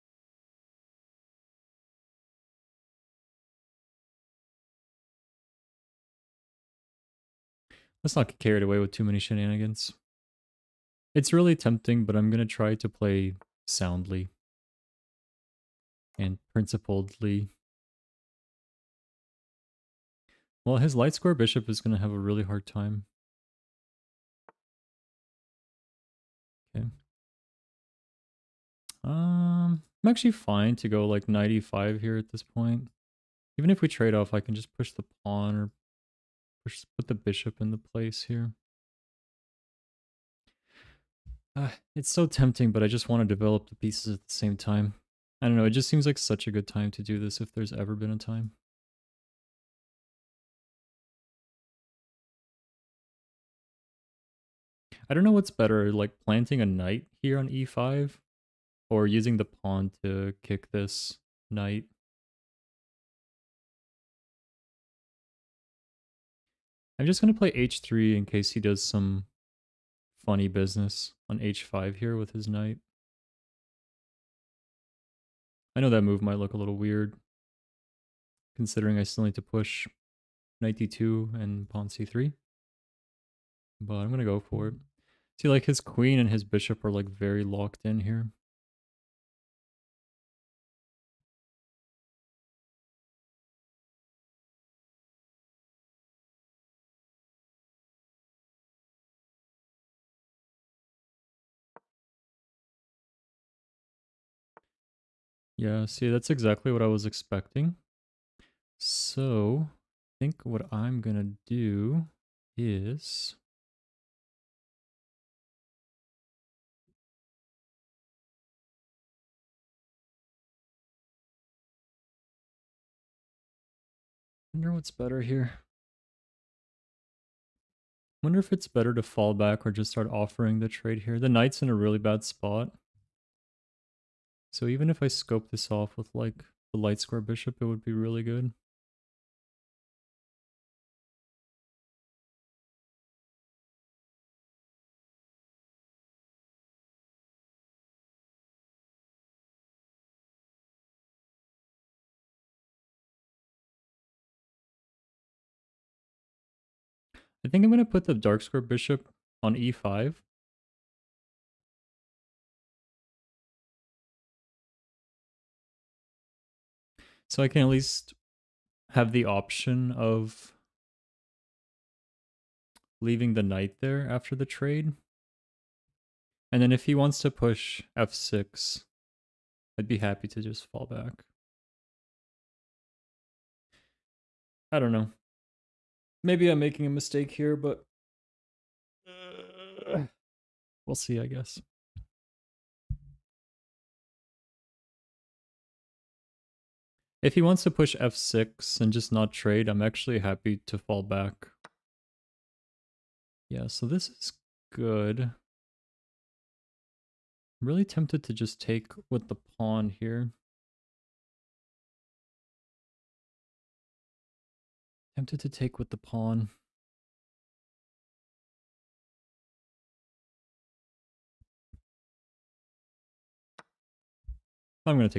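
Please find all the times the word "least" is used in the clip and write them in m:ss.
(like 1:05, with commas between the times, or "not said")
2:47.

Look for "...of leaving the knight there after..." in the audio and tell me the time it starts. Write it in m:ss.
2:49.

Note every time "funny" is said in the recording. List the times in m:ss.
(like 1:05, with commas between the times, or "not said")
1:10.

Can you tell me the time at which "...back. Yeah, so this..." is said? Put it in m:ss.
3:21.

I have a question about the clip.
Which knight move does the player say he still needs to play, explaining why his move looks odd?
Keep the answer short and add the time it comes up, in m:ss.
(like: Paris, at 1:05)
Knight d2, at 1:20.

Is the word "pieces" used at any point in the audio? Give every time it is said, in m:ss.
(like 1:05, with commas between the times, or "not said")
0:43.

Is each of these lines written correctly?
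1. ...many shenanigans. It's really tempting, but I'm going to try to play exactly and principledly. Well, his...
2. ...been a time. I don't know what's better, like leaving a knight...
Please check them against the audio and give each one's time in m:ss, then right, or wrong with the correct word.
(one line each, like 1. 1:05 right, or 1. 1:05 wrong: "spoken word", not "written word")
1. 0:09 wrong: "soundly", not "exactly"
2. 0:47 wrong: "planting", not "leaving".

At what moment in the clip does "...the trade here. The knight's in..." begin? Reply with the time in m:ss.
2:10.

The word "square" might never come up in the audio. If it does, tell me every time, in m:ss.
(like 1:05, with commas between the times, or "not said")
0:21, 2:17, 2:38.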